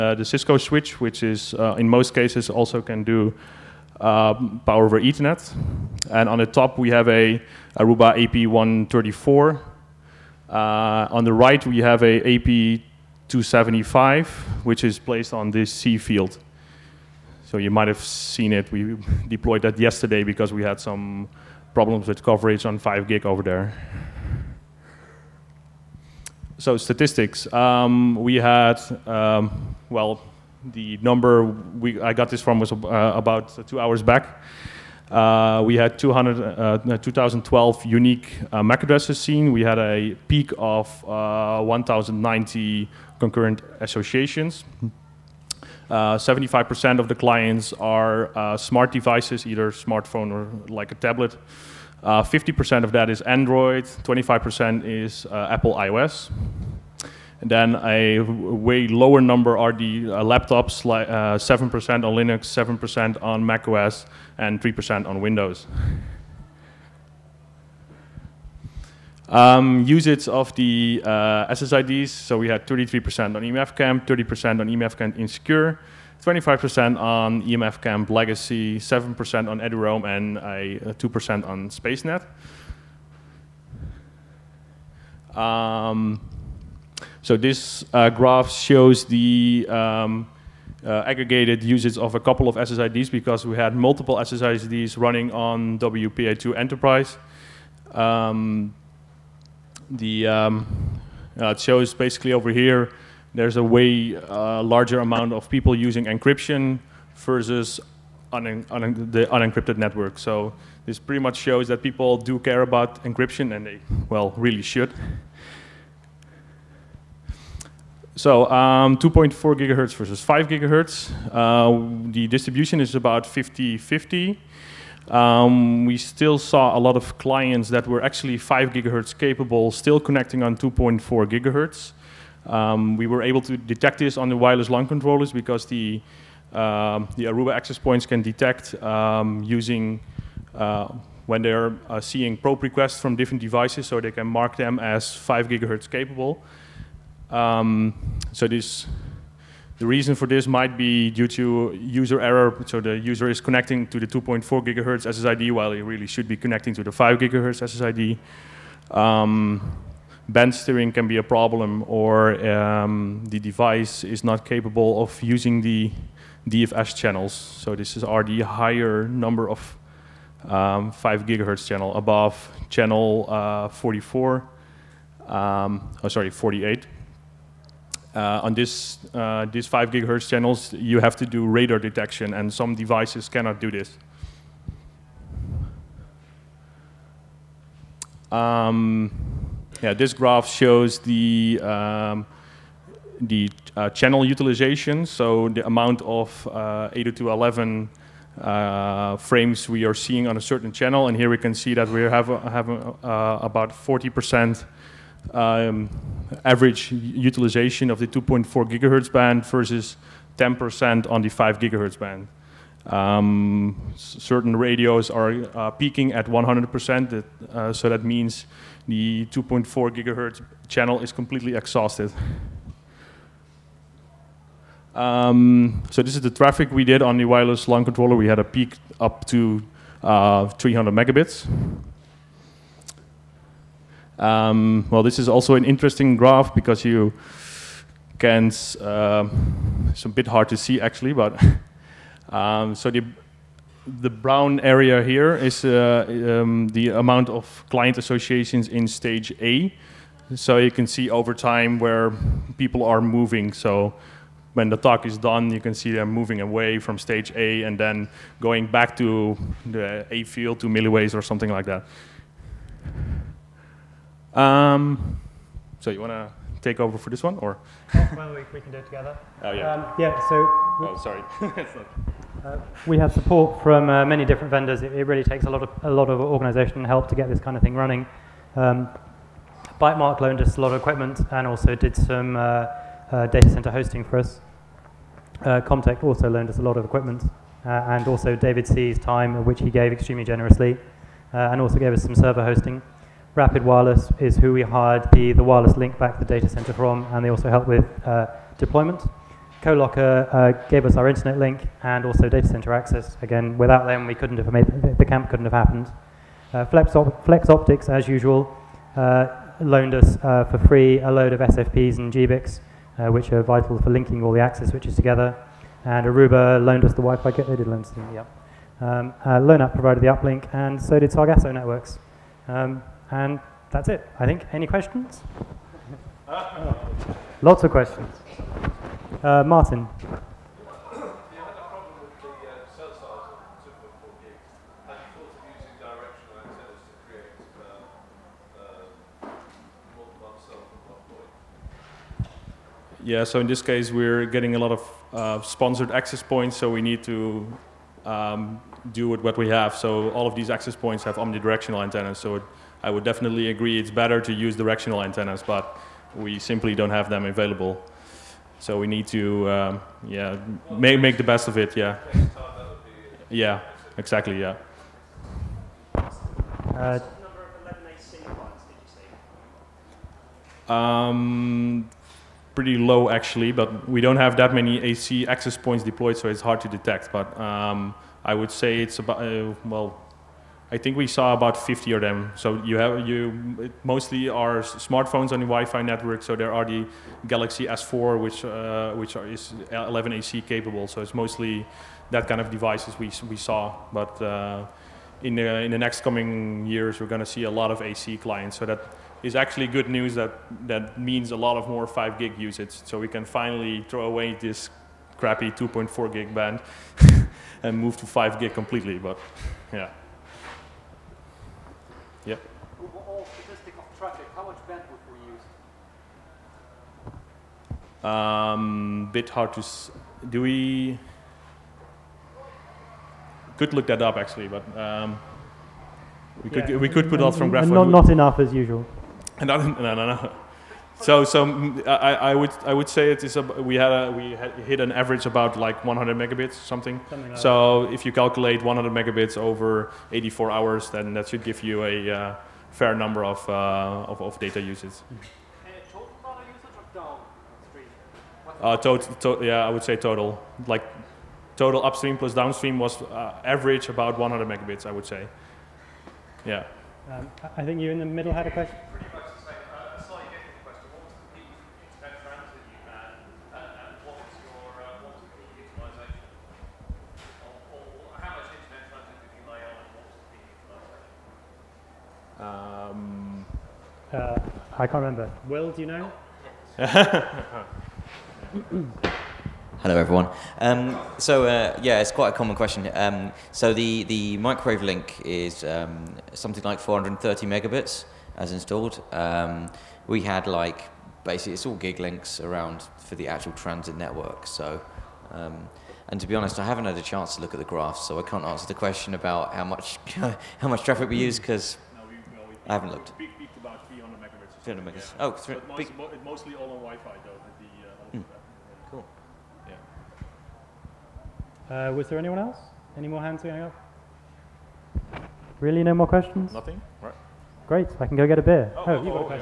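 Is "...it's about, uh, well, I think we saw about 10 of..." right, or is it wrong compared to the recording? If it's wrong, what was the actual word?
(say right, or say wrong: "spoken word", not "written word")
wrong: "50", not "10".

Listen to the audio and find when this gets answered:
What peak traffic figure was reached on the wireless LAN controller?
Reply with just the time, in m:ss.
3:50.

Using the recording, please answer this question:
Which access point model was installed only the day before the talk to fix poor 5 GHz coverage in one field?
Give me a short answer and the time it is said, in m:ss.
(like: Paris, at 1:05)
AP275, at 0:12.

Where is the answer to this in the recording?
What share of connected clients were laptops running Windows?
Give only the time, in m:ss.
1:04.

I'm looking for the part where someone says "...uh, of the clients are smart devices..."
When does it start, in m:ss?
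0:46.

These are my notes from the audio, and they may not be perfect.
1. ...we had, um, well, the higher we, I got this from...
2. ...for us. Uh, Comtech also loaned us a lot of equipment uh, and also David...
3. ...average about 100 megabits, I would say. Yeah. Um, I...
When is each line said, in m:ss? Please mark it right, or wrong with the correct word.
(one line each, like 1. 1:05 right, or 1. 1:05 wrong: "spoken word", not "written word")
1. 0:28 wrong: "number", not "higher"
2. 4:44 right
3. 7:33 right.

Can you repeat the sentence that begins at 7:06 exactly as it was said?
could we could put lots from graph.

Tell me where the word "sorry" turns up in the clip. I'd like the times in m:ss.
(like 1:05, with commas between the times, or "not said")
2:56, 4:31.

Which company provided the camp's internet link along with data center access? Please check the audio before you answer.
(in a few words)
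CoLocker.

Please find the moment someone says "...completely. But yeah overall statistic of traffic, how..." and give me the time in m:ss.
6:48.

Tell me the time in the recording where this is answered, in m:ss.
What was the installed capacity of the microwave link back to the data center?
8:06.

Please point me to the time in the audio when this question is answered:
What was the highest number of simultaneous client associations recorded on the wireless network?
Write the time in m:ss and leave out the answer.
0:41.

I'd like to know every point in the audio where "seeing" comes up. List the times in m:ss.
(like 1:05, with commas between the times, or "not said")
2:22, 3:19.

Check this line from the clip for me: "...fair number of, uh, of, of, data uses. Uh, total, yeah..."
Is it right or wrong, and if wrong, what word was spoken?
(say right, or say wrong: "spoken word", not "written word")
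right.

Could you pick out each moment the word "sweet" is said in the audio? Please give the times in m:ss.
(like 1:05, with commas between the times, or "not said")
not said.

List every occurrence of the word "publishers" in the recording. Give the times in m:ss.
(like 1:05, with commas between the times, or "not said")
not said.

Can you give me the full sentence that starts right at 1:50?
So this pretty much shows that people do care about encryption and they, well, really should.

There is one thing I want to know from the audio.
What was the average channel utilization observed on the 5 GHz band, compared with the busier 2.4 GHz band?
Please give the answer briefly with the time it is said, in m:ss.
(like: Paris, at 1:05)
10%, at 3:30.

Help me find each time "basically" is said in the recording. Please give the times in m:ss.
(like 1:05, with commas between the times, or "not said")
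1:41, 8:11.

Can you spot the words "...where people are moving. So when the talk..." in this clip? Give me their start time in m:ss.
4:11.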